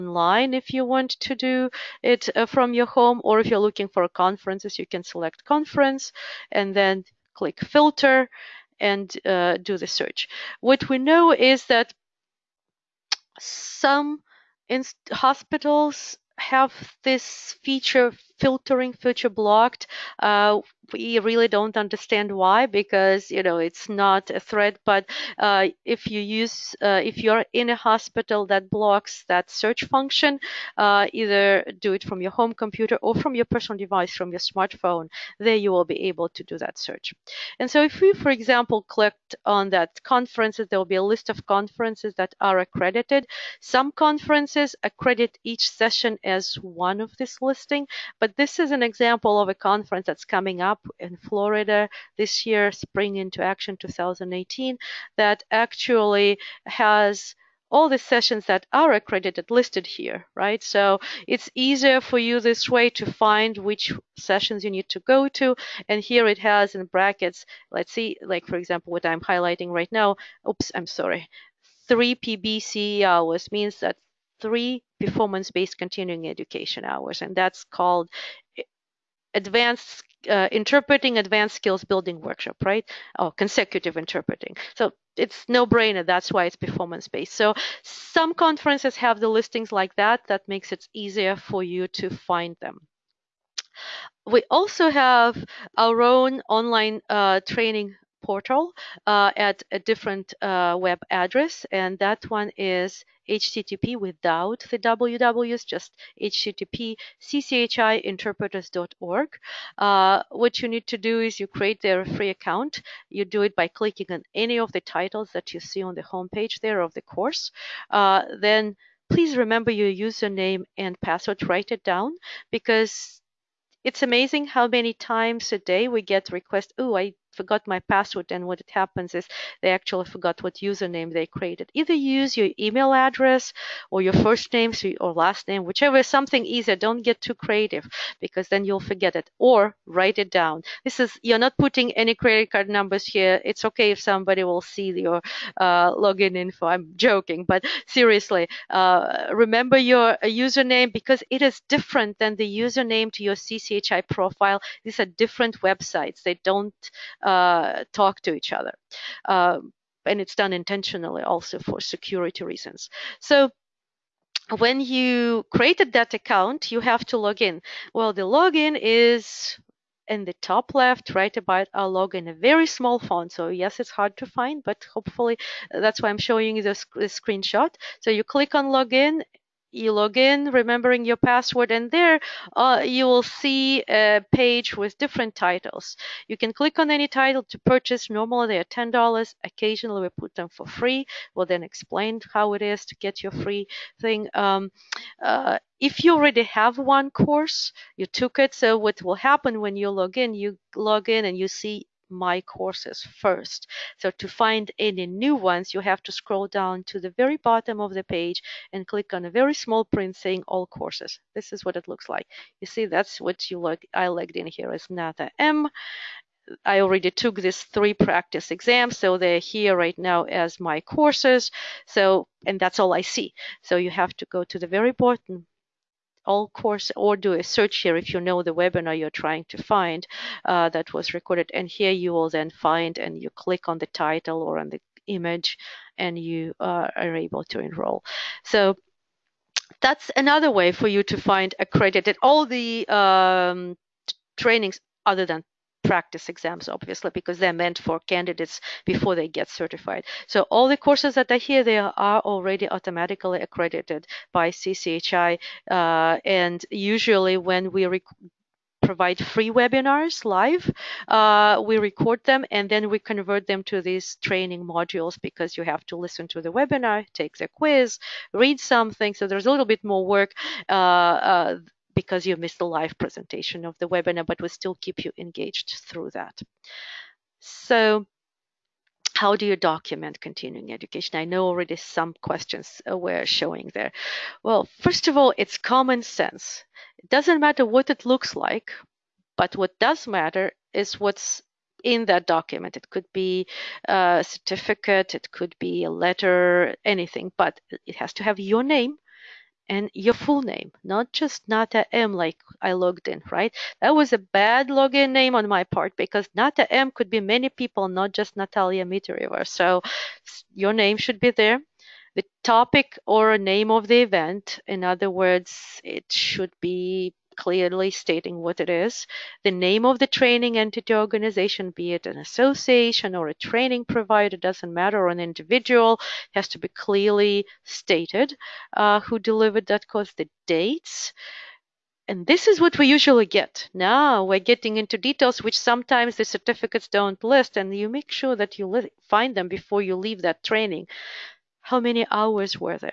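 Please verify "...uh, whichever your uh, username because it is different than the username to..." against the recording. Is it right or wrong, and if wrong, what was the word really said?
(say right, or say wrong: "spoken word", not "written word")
wrong: "remember", not "whichever".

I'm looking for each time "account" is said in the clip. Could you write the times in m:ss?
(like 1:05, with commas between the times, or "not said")
1:52, 2:46.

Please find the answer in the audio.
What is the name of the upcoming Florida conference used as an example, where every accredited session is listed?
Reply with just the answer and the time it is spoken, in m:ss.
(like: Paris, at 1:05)
Spring into Action 2018, at 0:52.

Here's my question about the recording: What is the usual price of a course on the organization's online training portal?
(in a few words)
$10.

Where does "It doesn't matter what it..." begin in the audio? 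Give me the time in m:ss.
4:46.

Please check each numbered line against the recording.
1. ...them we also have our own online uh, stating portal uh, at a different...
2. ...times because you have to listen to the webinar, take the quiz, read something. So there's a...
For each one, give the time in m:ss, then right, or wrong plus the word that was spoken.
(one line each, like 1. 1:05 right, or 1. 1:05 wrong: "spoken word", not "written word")
1. 1:32 wrong: "training", not "stating"
2. 4:24 wrong: "modules", not "times".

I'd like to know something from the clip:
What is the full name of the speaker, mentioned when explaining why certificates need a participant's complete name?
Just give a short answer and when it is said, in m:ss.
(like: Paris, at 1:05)
Natalya Mytareva, at 5:08.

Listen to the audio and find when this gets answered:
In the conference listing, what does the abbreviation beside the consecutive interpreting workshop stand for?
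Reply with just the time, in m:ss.
1:15.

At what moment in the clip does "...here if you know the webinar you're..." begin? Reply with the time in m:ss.
3:47.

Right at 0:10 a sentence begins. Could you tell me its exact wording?
What we know is that some hospitals have this feature filtering feature blocked.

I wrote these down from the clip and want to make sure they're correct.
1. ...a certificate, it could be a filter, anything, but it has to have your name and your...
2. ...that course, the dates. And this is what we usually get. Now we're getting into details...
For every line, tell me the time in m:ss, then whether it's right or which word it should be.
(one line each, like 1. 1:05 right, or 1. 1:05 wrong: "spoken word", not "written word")
1. 4:53 wrong: "letter", not "filter"
2. 5:29 right.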